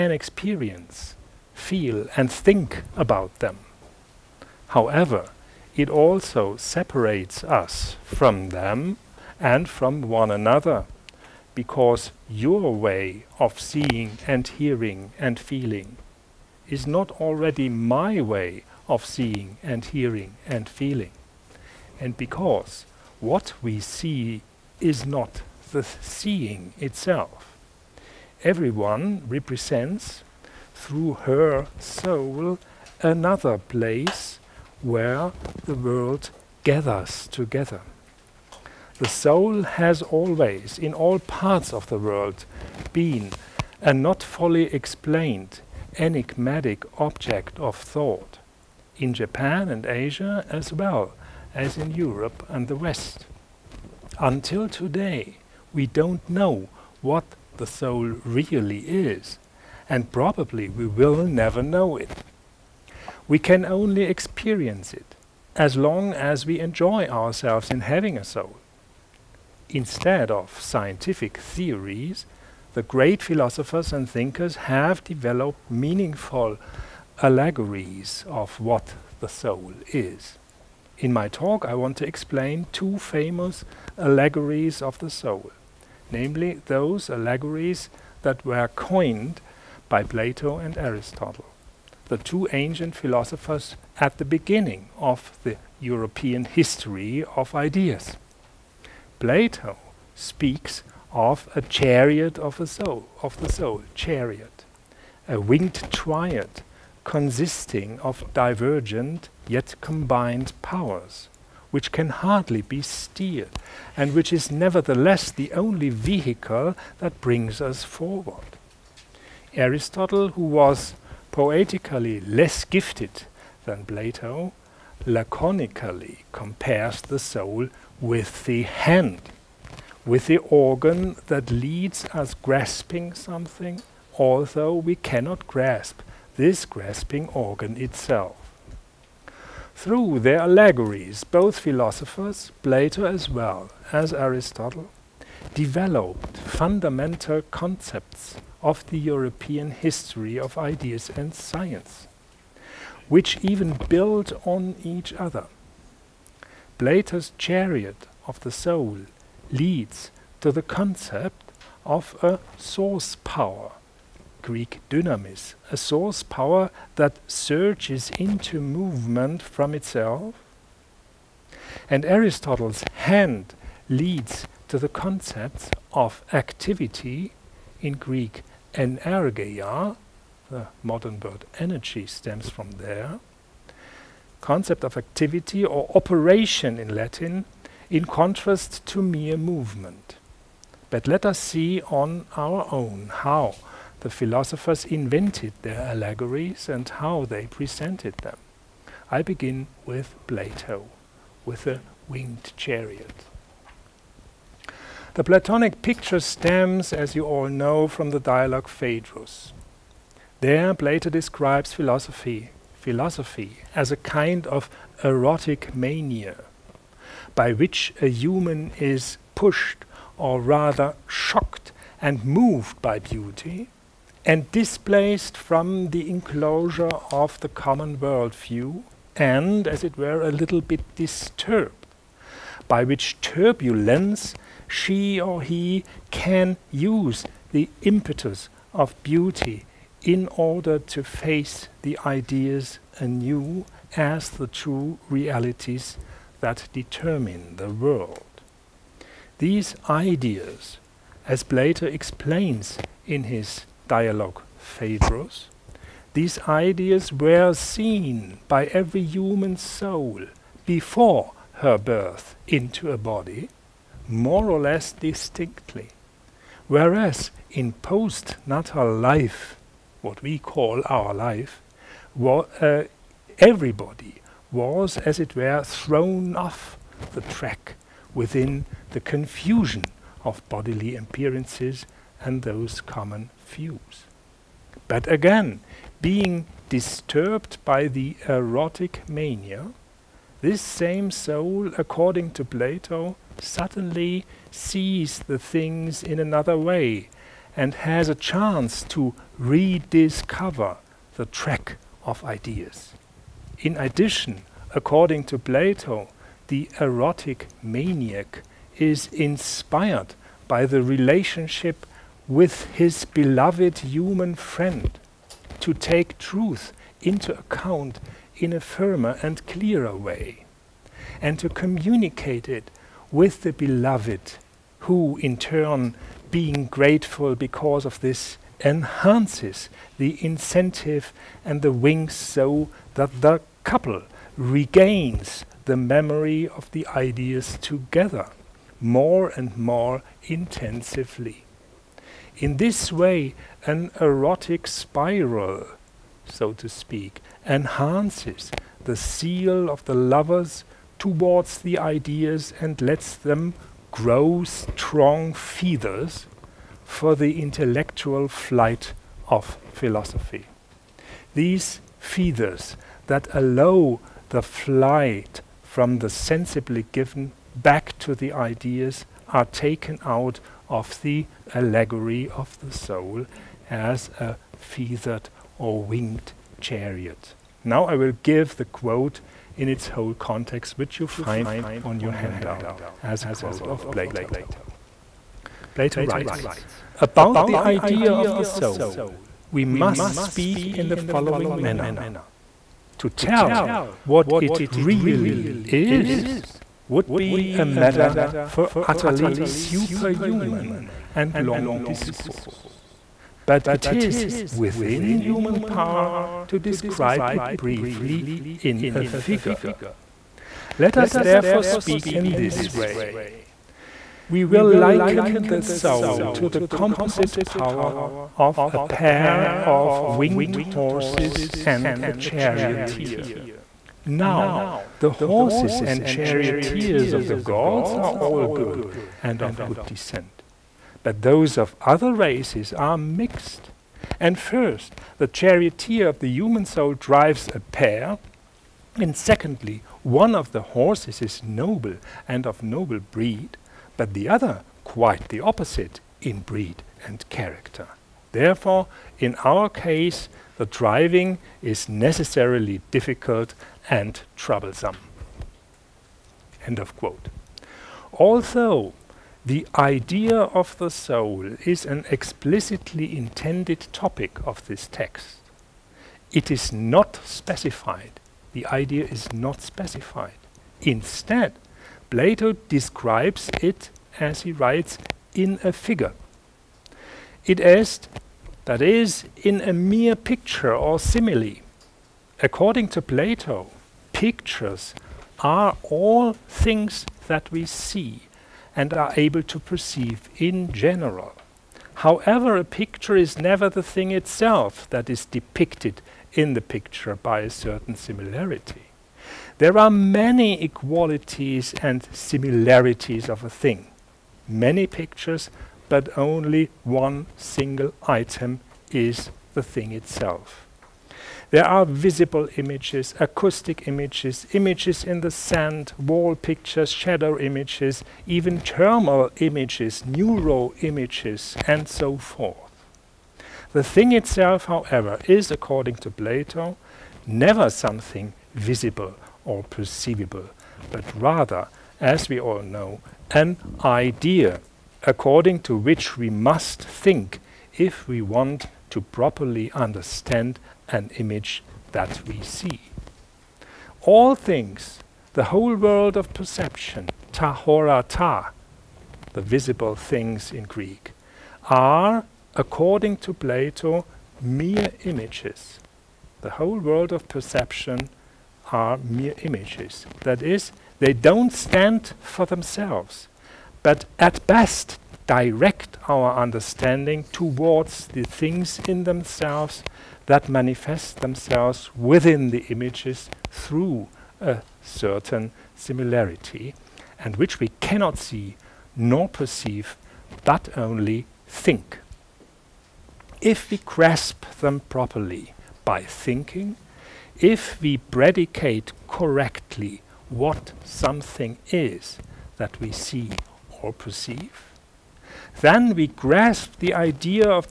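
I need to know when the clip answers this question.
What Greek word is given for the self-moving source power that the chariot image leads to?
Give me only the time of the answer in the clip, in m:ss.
2:44.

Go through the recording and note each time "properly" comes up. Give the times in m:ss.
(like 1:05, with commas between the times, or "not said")
8:59, 9:44.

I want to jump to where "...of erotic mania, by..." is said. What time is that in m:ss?
3:34.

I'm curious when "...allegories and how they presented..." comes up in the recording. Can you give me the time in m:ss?
3:15.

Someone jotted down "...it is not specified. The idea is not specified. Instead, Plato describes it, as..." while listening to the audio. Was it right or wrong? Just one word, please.
right.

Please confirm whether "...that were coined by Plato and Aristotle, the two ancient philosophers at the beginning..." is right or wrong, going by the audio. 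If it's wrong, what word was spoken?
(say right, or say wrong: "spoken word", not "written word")
right.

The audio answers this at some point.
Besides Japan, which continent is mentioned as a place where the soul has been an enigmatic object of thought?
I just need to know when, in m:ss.
0:49.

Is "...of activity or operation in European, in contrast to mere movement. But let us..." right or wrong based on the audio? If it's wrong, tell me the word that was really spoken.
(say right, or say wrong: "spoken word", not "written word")
wrong: "Latin", not "European".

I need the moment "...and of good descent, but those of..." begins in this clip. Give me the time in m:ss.
7:09.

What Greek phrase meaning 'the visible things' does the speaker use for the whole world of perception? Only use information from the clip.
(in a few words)
ta horata.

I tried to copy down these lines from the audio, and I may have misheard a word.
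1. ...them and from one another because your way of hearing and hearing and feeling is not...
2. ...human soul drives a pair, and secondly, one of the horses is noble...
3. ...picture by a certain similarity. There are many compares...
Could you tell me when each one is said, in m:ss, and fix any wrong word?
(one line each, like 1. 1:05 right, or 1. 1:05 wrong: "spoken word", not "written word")
1. 0:08 wrong: "seeing", not "hearing"
2. 7:16 right
3. 8:16 wrong: "equalities", not "compares".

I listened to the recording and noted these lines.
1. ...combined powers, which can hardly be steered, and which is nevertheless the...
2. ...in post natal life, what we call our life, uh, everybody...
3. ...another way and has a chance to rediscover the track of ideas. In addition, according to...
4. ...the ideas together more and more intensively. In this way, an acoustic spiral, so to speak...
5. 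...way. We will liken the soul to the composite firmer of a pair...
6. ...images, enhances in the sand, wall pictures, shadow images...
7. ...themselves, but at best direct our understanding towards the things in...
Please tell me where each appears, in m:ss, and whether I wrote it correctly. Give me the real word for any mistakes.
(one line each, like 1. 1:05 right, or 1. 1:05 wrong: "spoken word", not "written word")
1. 1:49 right
2. 4:27 right
3. 4:56 right
4. 5:36 wrong: "erotic", not "acoustic"
5. 6:52 wrong: "power", not "firmer"
6. 8:33 wrong: "images", not "enhances"
7. 9:22 right.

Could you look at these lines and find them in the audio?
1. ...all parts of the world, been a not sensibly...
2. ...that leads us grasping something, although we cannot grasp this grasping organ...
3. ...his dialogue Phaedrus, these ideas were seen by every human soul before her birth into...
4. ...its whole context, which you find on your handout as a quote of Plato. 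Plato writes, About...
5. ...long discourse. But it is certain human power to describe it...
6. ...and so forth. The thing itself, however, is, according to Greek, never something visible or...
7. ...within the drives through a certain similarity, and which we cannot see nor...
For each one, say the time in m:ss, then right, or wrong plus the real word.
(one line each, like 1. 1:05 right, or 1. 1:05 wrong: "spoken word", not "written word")
1. 0:40 wrong: "fully", not "sensibly"
2. 2:11 right
3. 4:13 right
4. 6:19 right
5. 6:41 wrong: "within", not "certain"
6. 8:41 wrong: "Plato", not "Greek"
7. 9:31 wrong: "images", not "drives".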